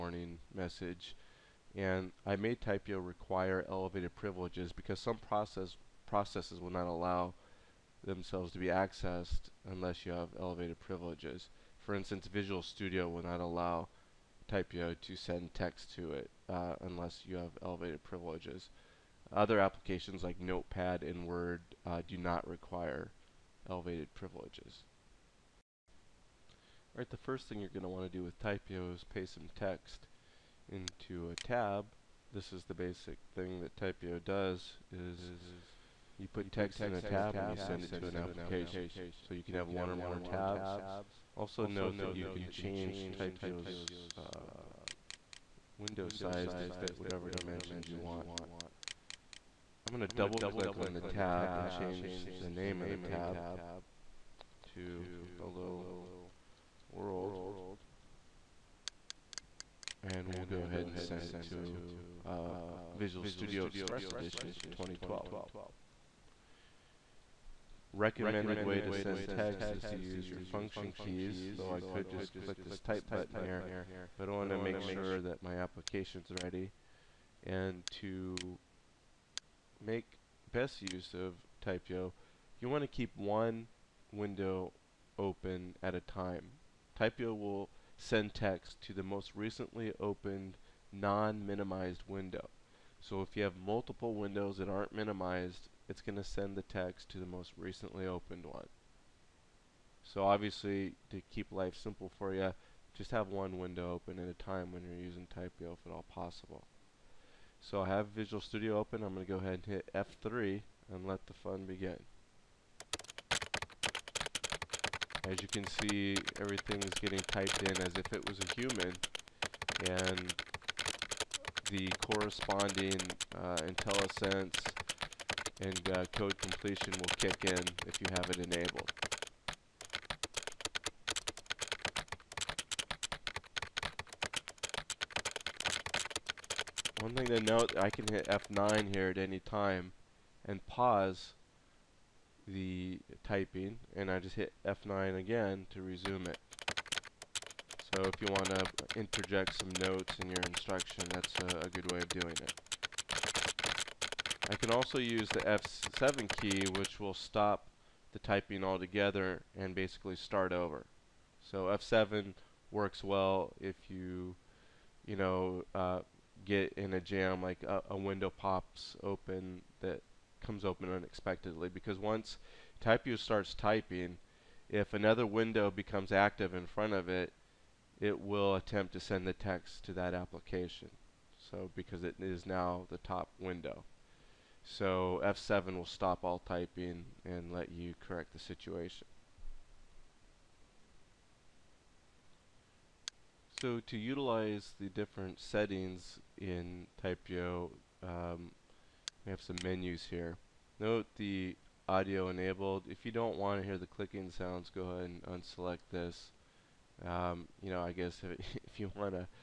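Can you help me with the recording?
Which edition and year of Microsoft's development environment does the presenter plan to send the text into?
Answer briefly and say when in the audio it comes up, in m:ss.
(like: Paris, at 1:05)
Express Edition for 2012, at 1:03.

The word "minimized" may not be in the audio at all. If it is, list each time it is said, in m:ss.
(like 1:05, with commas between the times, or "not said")
1:30, 1:34.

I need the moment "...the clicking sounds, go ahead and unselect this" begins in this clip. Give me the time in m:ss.
3:23.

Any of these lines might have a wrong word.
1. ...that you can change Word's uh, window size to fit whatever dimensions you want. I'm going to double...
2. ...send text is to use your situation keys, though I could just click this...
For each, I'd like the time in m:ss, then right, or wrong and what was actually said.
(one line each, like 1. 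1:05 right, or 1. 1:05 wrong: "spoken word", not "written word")
1. 0:41 wrong: "TypYo", not "Word"
2. 1:08 wrong: "function", not "situation".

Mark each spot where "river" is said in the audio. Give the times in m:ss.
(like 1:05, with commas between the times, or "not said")
not said.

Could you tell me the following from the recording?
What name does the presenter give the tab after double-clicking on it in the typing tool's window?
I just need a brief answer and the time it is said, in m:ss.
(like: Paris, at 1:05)
Hello World, at 0:55.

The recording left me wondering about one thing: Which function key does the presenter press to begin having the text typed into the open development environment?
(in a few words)
F3.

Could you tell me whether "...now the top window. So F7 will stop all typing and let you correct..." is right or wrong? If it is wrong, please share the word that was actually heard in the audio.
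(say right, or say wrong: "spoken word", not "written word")
right.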